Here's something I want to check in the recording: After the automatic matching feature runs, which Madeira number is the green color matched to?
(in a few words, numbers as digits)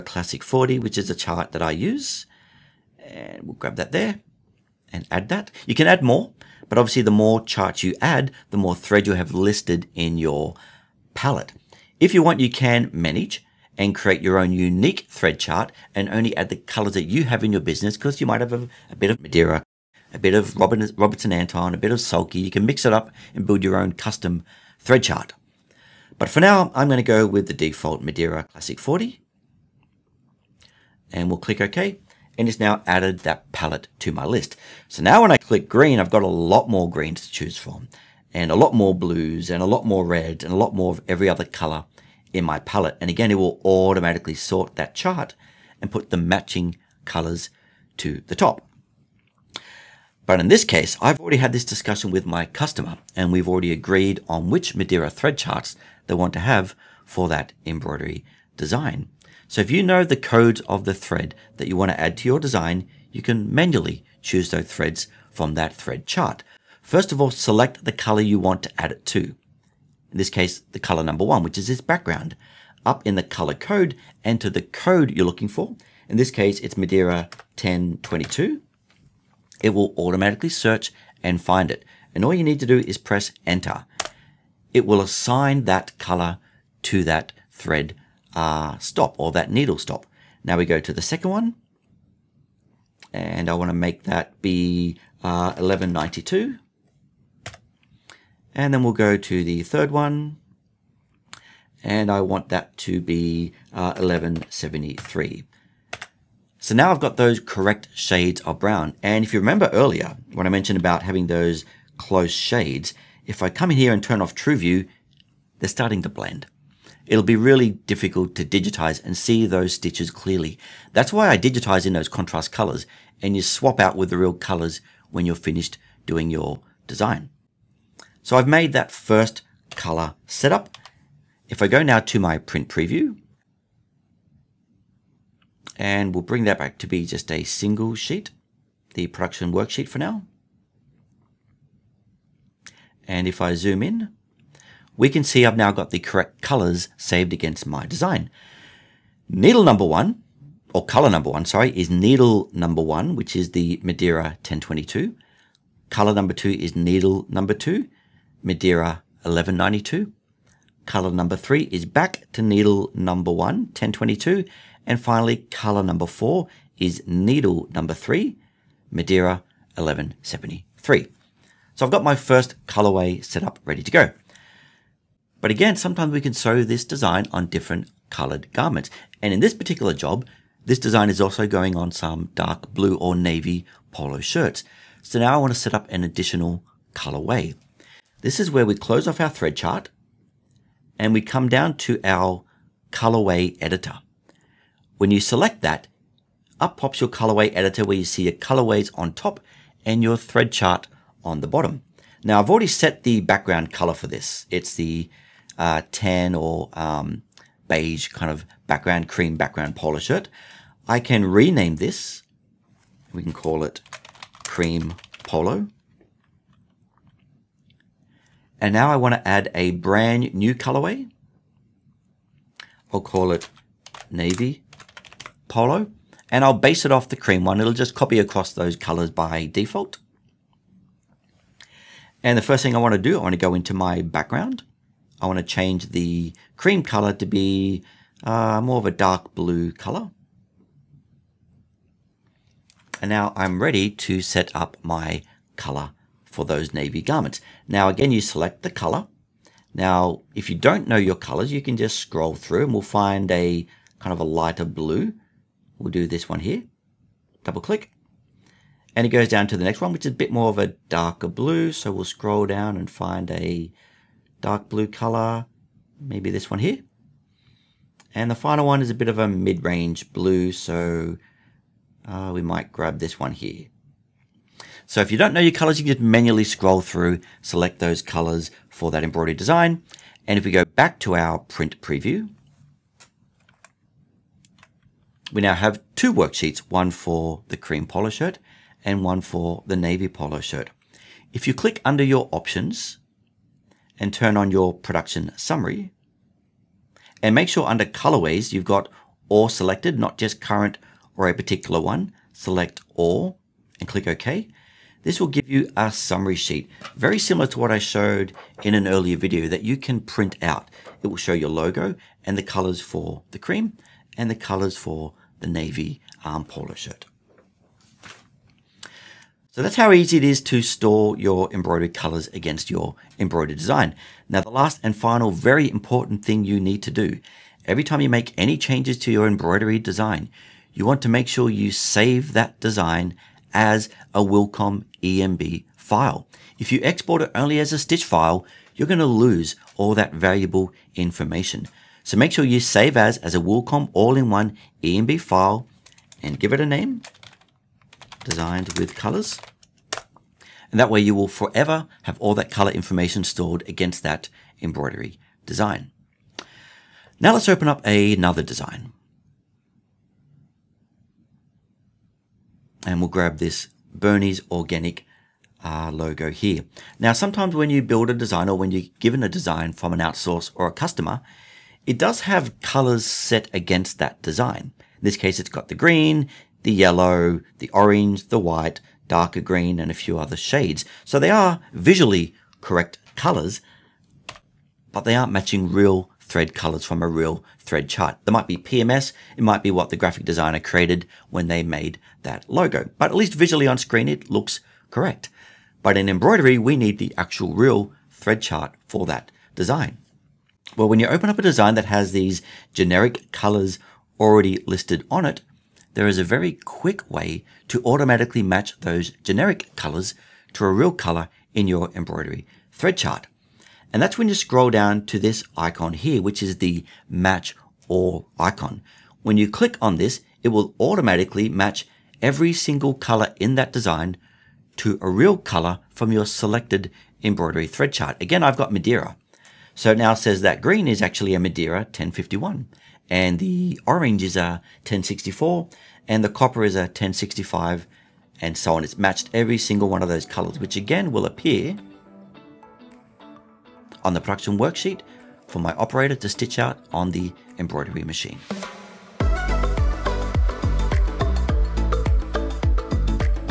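1051.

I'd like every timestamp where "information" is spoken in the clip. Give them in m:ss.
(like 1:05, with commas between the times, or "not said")
5:40, 5:52.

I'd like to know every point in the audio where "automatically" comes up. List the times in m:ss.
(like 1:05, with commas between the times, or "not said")
0:43, 1:19, 6:47, 7:00.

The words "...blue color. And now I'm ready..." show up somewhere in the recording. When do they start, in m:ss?
3:59.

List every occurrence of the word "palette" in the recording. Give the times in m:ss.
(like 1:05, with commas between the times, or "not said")
0:11, 0:33, 0:42.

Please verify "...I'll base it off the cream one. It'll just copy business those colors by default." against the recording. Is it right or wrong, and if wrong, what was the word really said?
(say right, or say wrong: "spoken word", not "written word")
wrong: "across", not "business".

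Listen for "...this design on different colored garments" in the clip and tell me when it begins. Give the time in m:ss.
2:56.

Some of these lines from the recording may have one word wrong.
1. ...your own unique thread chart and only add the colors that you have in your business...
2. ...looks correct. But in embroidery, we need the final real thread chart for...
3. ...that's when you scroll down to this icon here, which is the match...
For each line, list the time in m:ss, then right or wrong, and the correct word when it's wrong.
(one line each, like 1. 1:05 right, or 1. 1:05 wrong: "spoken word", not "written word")
1. 0:14 right
2. 6:34 wrong: "actual", not "final"
3. 6:54 right.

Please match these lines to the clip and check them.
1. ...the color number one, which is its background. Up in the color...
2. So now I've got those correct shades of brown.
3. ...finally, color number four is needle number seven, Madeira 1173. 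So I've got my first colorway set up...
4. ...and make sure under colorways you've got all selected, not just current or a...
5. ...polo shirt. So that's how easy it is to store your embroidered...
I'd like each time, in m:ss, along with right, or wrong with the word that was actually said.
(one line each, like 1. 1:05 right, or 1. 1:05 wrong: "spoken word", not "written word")
1. 1:10 right
2. 1:46 right
3. 2:45 wrong: "three", not "seven"
4. 4:57 right
5. 5:16 right.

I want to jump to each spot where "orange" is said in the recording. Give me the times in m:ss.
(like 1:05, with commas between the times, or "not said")
6:17, 7:13.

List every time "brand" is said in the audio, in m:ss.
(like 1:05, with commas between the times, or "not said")
3:39.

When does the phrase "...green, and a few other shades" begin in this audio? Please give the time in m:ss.
6:19.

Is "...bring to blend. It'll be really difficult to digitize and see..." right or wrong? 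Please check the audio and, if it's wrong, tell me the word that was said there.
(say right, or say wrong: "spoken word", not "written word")
wrong: "starting", not "bring".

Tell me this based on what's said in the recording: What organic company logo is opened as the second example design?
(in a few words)
Bernie's Organic.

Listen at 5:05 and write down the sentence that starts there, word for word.
This will give you a summary sheet, very similar to what I showed in an earlier video that you can print out.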